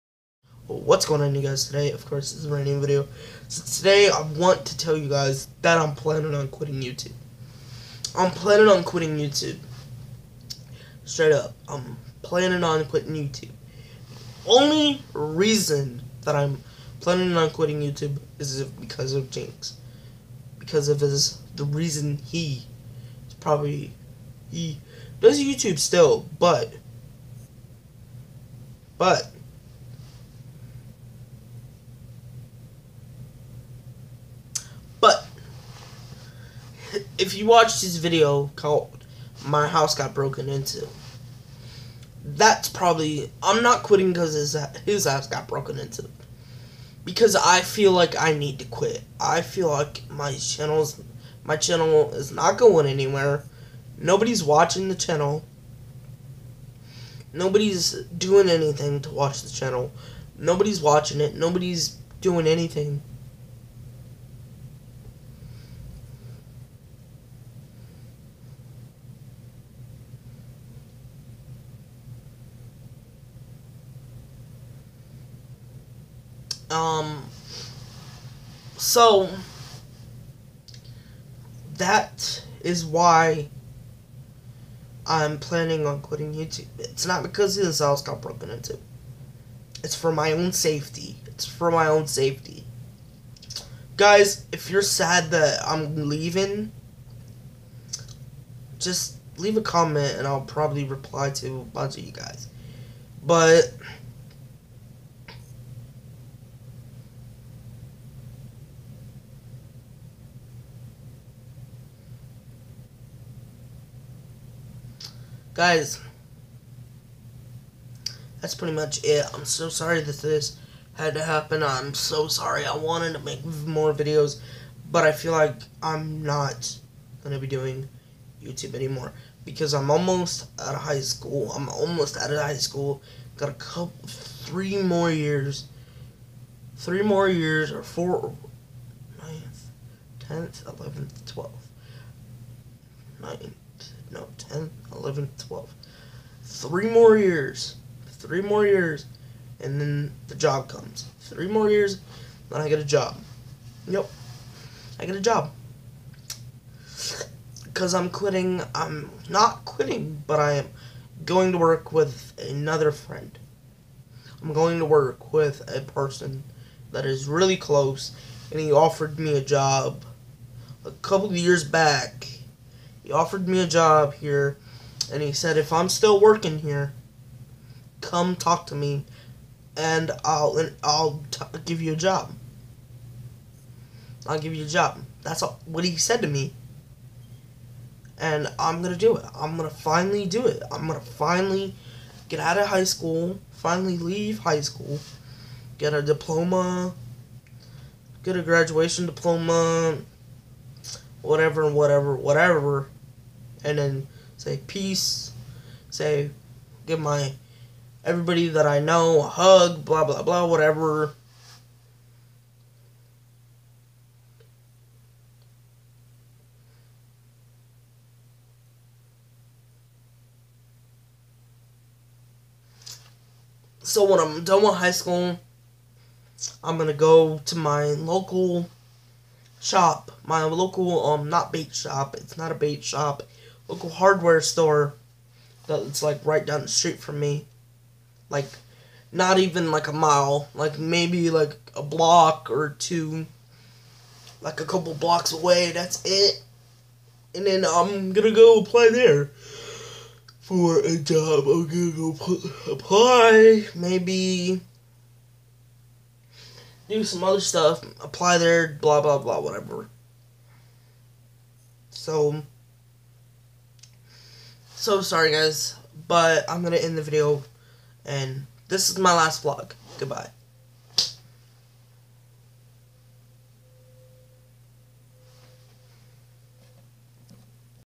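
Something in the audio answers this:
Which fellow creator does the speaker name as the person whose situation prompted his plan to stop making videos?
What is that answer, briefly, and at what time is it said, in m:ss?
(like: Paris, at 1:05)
Jinx, at 0:19.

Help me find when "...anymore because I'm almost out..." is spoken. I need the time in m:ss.
2:08.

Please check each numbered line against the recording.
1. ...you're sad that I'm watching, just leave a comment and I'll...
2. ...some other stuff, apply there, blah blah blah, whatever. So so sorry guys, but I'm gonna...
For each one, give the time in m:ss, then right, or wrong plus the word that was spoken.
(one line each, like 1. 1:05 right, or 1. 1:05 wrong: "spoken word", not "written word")
1. 1:34 wrong: "leaving", not "watching"
2. 4:17 right.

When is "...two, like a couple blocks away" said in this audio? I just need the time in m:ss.
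4:02.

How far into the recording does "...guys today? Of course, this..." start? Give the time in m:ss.
0:01.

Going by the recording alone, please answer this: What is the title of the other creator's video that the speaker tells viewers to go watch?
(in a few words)
My House Got Broken Into.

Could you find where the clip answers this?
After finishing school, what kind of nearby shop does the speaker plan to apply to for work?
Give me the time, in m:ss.
3:53.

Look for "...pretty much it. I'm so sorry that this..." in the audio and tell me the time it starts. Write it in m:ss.
1:58.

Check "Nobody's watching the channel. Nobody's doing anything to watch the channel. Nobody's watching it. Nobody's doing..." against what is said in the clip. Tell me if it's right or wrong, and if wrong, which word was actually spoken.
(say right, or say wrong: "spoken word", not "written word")
right.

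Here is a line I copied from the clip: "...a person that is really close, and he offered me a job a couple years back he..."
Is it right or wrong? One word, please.
right.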